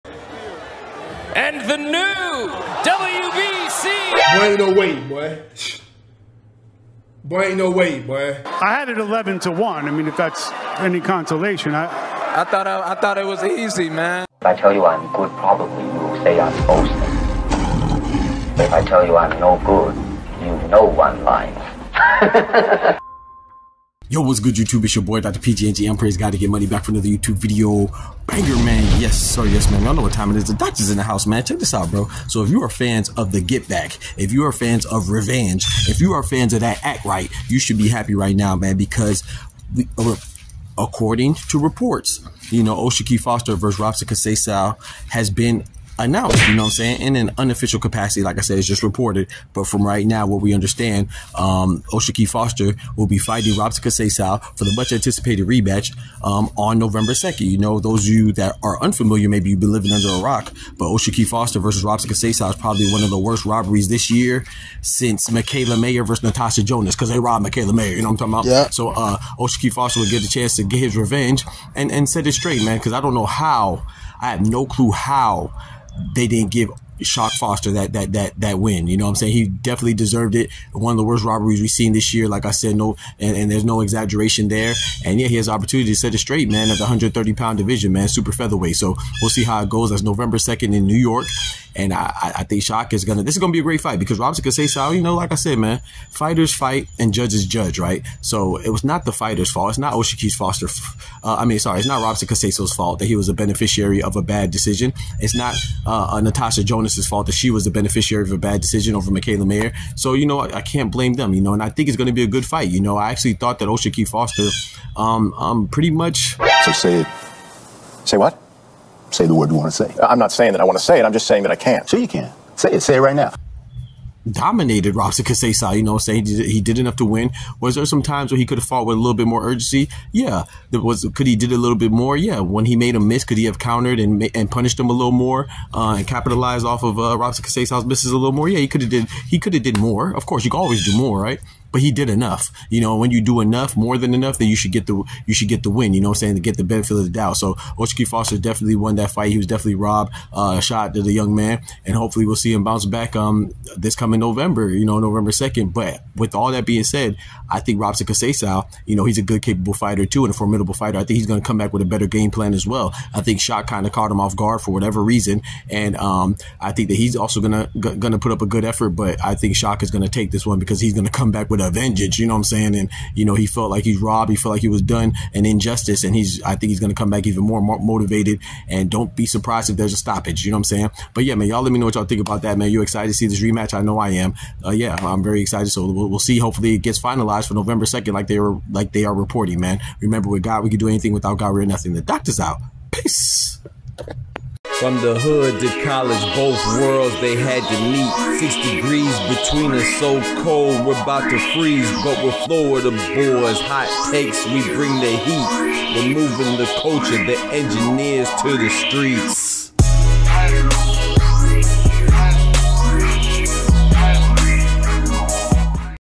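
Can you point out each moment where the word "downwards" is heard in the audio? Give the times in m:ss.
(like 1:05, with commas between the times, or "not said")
not said.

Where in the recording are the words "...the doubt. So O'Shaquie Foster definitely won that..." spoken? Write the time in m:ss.
2:27.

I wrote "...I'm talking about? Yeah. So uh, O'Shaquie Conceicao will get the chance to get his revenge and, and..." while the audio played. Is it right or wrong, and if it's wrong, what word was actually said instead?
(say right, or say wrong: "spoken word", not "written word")
wrong: "Foster", not "Conceicao".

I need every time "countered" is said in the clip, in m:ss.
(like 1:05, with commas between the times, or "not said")
2:13.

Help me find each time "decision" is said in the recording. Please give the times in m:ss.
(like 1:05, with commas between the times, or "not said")
1:44, 1:48.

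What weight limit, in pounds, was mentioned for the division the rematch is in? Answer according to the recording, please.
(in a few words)
130.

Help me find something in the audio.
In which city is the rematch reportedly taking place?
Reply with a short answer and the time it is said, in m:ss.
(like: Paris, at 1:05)
New York, at 1:30.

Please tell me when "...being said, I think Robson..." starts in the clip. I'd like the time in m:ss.
2:36.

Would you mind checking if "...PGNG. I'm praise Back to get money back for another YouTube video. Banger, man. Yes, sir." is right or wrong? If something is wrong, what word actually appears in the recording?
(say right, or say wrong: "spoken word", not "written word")
wrong: "God", not "Back".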